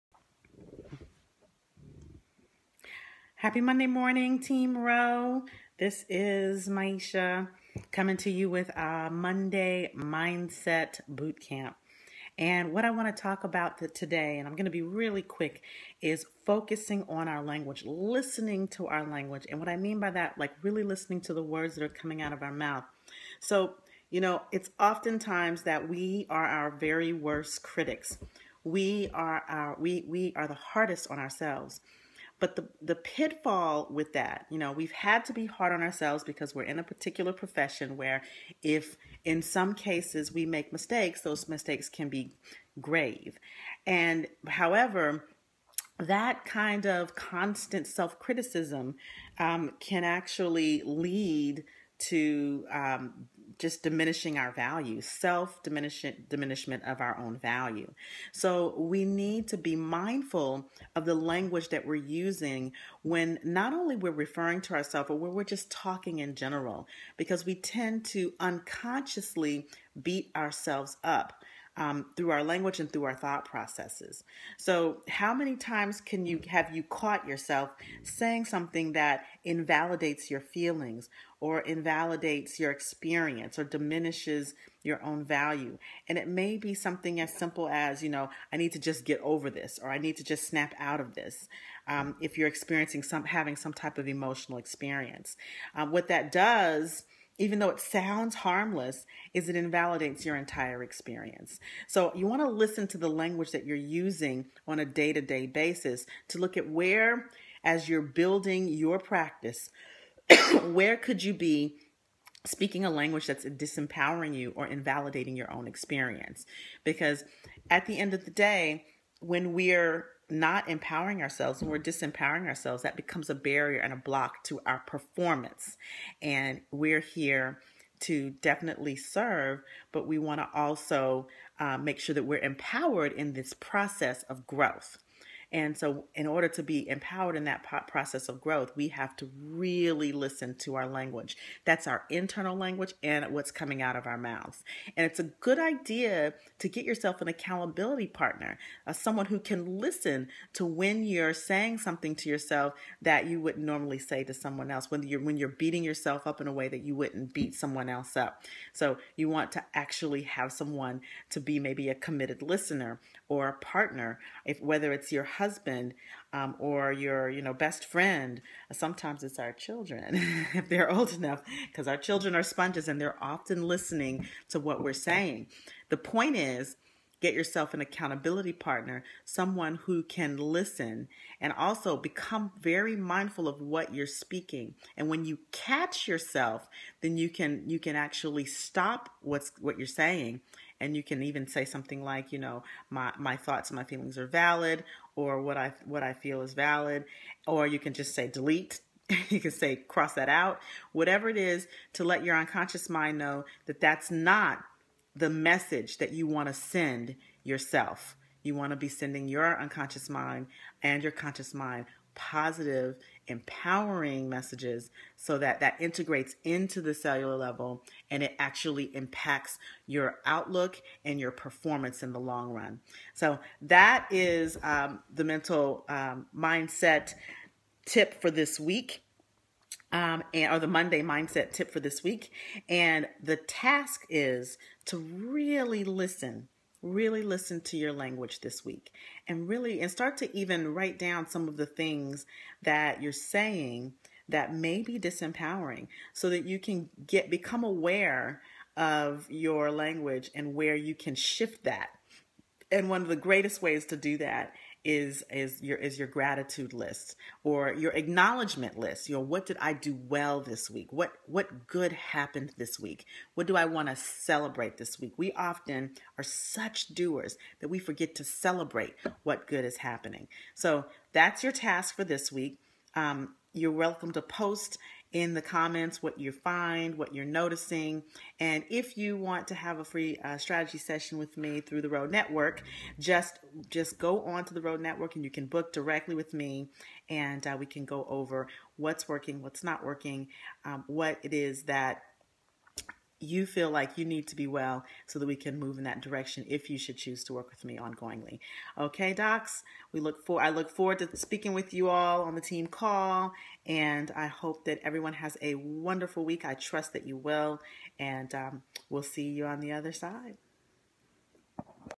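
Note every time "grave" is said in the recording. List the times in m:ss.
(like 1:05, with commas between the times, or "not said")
0:42.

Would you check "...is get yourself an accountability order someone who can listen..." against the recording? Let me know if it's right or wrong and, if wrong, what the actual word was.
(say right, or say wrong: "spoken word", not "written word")
wrong: "partner", not "order".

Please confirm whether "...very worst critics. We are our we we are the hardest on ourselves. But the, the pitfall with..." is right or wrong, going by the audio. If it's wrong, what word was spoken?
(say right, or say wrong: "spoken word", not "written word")
right.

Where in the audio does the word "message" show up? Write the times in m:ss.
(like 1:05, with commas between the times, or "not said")
3:25, 3:34.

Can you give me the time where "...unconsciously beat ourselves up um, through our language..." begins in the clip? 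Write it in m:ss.
1:08.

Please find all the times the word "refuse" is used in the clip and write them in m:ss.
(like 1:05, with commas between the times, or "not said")
not said.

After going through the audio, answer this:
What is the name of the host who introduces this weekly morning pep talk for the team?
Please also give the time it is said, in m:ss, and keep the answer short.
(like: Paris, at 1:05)
Maiysha, at 0:06.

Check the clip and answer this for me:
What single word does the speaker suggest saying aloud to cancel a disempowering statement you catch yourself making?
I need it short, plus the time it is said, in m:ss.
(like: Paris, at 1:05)
delete, at 3:18.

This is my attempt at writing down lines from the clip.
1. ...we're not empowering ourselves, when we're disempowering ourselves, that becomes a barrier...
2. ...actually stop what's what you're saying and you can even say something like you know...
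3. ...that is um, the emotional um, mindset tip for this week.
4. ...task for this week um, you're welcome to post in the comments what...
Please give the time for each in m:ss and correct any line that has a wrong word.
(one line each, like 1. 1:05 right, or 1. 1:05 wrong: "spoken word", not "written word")
1. 1:59 right
2. 3:07 right
3. 3:43 wrong: "mental", not "emotional"
4. 4:31 right.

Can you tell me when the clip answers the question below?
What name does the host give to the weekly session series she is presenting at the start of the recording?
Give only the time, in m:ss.
0:09.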